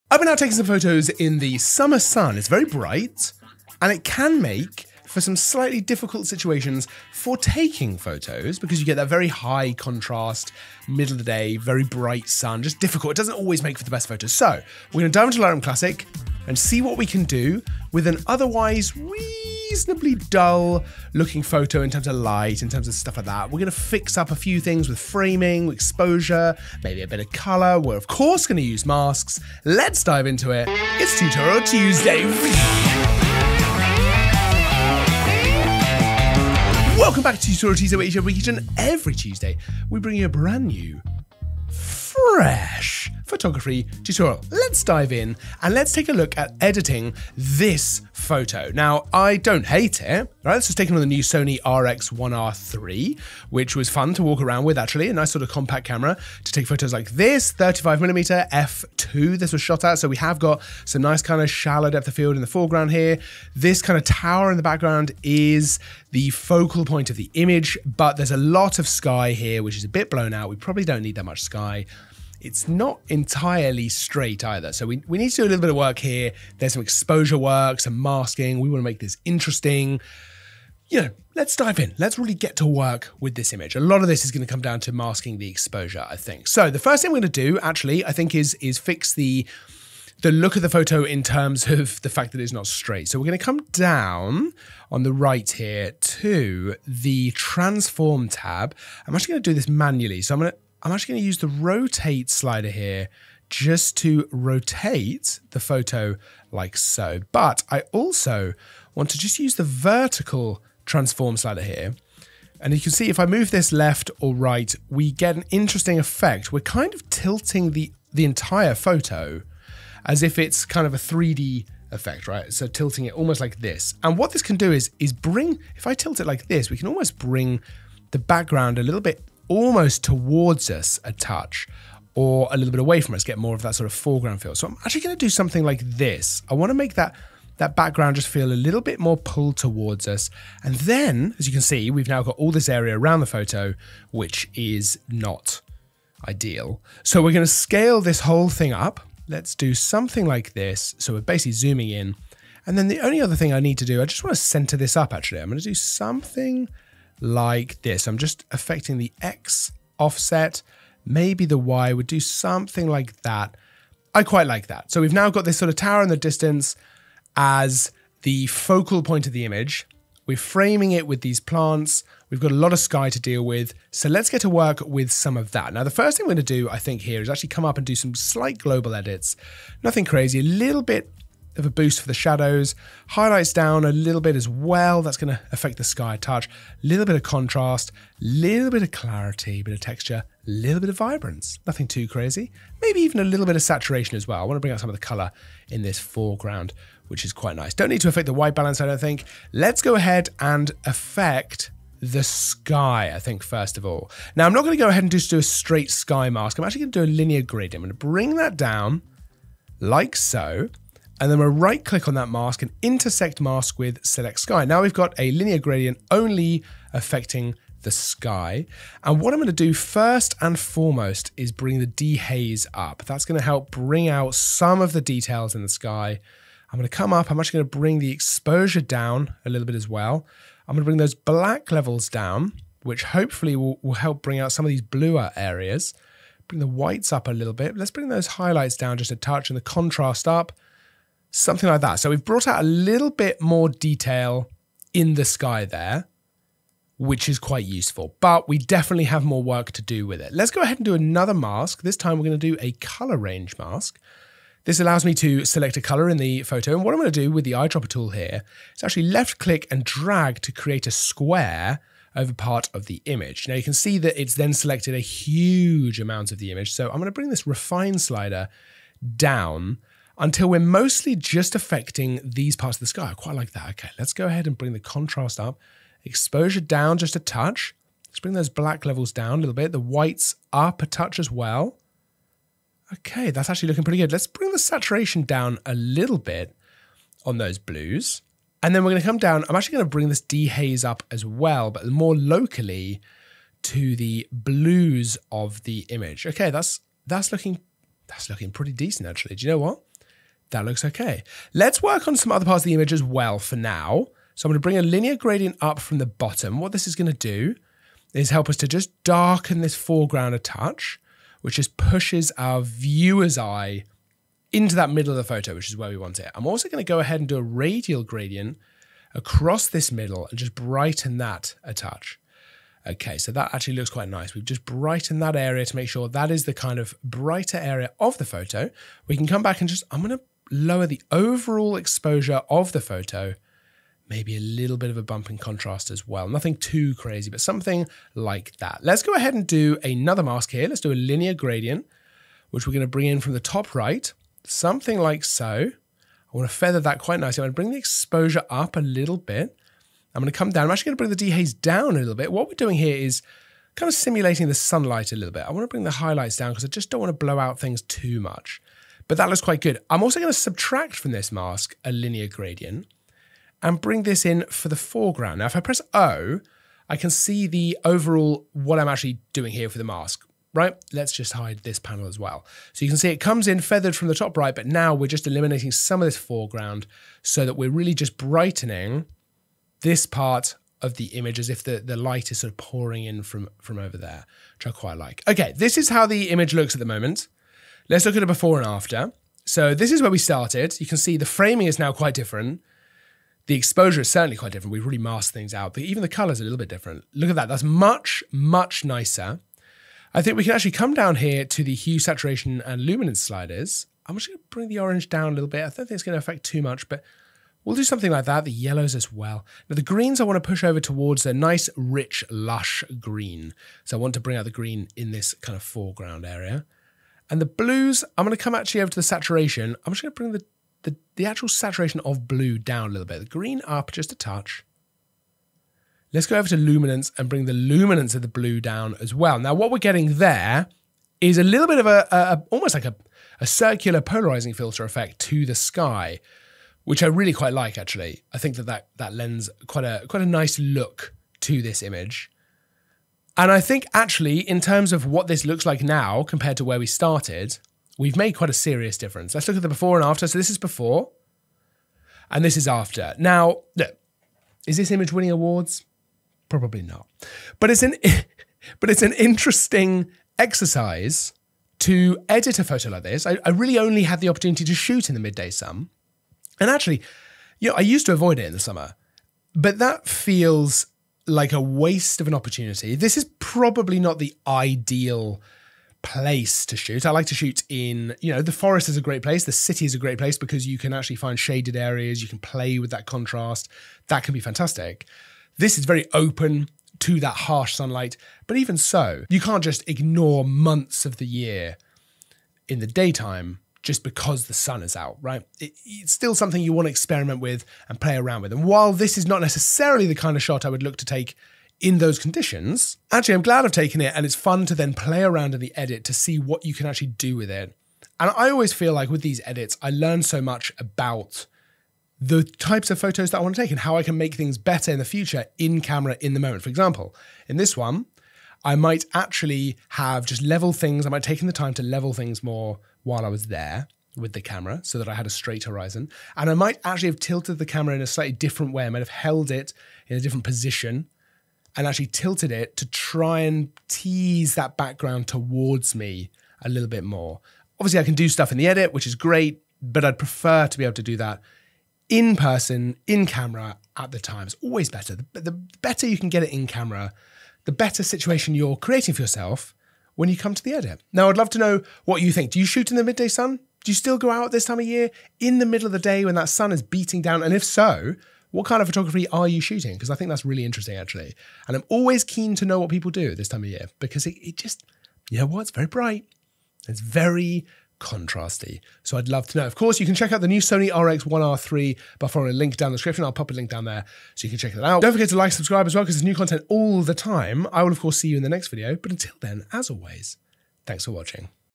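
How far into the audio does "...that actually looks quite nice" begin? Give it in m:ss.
5:23.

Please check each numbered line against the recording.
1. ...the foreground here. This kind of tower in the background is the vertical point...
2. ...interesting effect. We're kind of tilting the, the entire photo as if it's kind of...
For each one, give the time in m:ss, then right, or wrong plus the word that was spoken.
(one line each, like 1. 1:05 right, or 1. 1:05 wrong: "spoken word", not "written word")
1. 1:02 wrong: "focal", not "vertical"
2. 1:55 right.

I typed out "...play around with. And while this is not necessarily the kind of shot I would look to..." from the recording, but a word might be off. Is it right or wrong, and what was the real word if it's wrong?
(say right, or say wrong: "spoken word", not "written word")
right.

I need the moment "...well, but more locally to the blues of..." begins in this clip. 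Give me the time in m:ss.
4:51.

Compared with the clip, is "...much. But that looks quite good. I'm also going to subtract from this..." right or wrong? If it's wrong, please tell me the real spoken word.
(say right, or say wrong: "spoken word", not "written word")
right.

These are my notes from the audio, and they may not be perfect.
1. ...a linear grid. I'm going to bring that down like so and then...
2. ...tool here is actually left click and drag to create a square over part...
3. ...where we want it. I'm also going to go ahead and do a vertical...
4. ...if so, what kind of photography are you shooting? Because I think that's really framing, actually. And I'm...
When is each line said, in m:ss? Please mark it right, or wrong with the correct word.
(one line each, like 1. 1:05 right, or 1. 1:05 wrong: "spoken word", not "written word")
1. 3:27 right
2. 4:17 right
3. 5:15 wrong: "radial", not "vertical"
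4. 9:17 wrong: "interesting", not "framing".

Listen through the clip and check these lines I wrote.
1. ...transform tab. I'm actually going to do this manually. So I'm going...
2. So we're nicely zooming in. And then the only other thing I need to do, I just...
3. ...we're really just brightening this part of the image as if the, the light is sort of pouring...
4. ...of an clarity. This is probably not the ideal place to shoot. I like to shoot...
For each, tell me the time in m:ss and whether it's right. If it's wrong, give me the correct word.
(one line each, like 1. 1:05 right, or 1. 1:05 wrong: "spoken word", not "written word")
1. 1:37 right
2. 2:30 wrong: "basically", not "nicely"
3. 6:17 right
4. 7:52 wrong: "opportunity", not "clarity".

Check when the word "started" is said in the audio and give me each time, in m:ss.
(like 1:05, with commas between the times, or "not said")
6:30, 7:26.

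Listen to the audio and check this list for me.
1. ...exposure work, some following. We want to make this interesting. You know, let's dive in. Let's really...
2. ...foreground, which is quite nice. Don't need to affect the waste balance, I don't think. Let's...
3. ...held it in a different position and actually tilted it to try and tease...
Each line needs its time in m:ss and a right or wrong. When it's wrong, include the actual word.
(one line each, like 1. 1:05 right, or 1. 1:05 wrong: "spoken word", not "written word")
1. 1:16 wrong: "masking", not "following"
2. 3:15 wrong: "white", not "waste"
3. 8:49 right.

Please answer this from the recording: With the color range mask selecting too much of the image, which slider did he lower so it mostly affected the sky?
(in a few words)
refine.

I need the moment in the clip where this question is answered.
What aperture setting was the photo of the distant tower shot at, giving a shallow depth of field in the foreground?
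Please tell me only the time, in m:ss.
0:58.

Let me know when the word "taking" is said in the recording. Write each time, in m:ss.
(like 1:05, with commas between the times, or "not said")
0:00, 0:07.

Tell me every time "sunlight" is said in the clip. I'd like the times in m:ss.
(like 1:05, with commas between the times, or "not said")
5:54, 8:07.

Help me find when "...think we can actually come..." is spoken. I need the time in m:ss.
6:40.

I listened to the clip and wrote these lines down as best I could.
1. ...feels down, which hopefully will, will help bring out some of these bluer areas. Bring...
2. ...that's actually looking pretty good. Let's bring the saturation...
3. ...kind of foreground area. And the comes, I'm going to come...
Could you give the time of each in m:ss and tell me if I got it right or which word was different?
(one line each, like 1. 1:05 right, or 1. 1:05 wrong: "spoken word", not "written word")
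1. 3:51 wrong: "levels", not "feels"
2. 4:43 right
3. 6:55 wrong: "blues", not "comes".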